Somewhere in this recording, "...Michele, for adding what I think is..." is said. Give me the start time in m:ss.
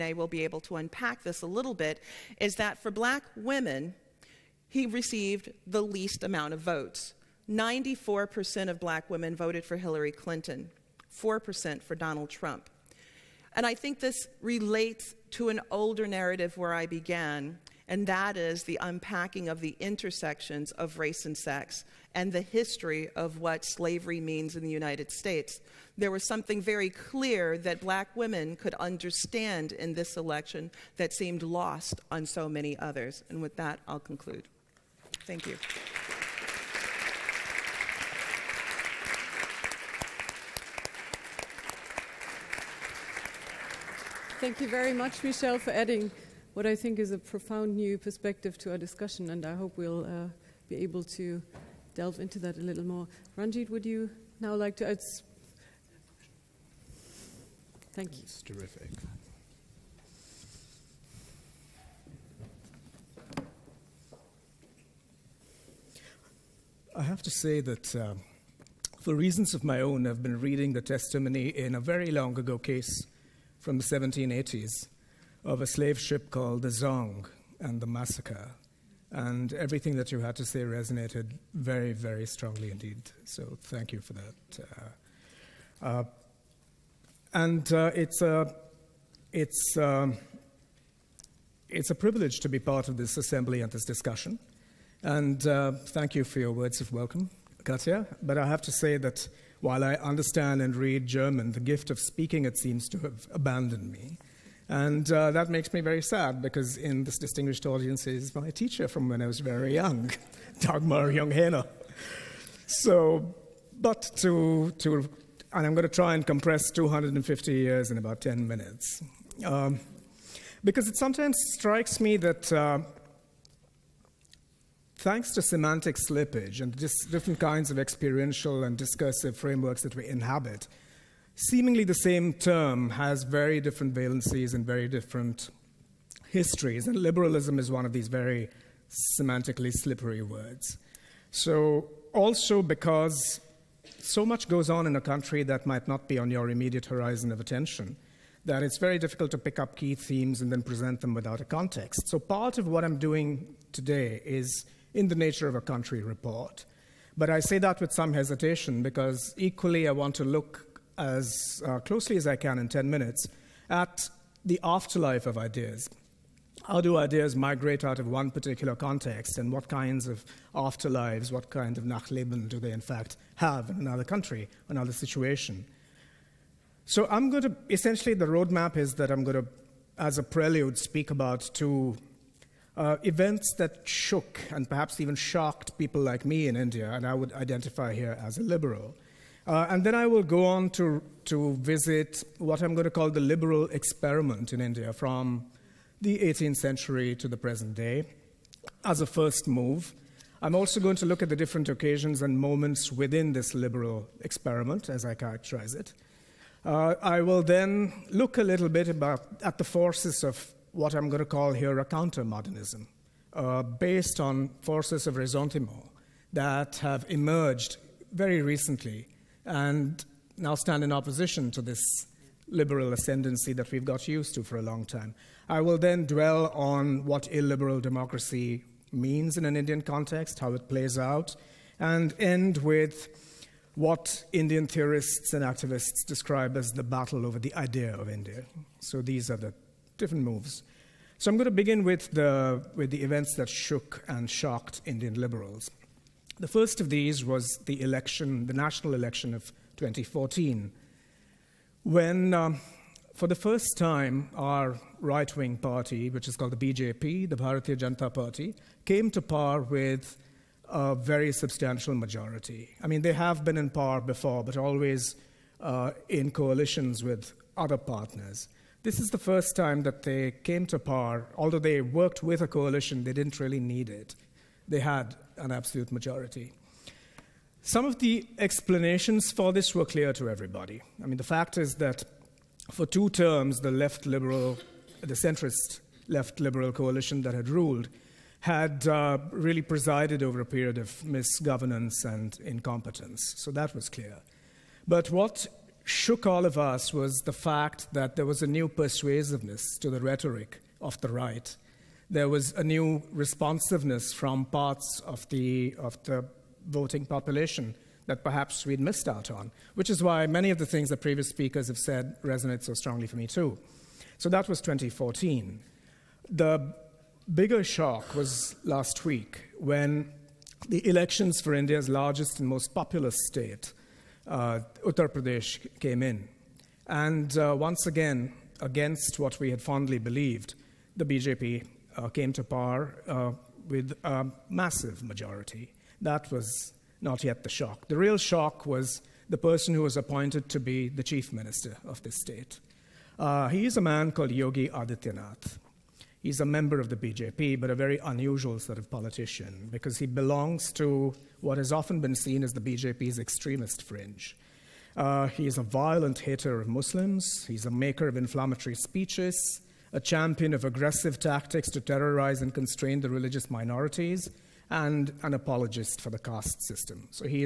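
0:45.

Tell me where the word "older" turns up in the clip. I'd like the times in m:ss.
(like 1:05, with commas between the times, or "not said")
0:15.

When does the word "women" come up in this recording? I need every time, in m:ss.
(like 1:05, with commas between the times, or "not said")
0:03, 0:09, 0:28.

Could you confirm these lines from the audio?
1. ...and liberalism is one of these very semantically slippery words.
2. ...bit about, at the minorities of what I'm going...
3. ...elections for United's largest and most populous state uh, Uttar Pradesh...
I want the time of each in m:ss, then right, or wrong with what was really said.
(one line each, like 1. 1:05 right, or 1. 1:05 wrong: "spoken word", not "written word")
1. 2:16 right
2. 3:28 wrong: "forces", not "minorities"
3. 5:20 wrong: "India", not "United".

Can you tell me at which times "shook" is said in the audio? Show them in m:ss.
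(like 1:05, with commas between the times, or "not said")
3:03, 4:03, 4:55.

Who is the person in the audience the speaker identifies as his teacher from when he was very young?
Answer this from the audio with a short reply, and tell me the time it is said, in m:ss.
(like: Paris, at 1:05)
Dagmar Junghena, at 1:50.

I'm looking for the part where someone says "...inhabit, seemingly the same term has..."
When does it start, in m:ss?
2:10.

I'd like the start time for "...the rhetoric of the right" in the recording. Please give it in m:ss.
4:59.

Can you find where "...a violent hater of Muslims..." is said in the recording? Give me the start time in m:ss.
5:55.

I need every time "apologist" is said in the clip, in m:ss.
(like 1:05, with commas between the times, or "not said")
6:05.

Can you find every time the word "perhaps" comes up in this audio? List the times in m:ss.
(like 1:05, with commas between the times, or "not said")
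3:04, 5:08.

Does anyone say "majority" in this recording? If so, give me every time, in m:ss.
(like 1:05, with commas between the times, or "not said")
4:21, 4:35, 5:35.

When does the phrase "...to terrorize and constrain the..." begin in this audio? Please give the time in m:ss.
6:01.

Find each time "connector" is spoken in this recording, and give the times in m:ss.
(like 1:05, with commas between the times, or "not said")
not said.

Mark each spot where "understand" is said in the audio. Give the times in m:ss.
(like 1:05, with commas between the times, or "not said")
0:28, 1:39.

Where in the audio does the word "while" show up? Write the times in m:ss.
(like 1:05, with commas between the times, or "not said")
1:39.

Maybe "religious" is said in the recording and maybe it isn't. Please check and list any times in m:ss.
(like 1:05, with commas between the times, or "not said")
6:03.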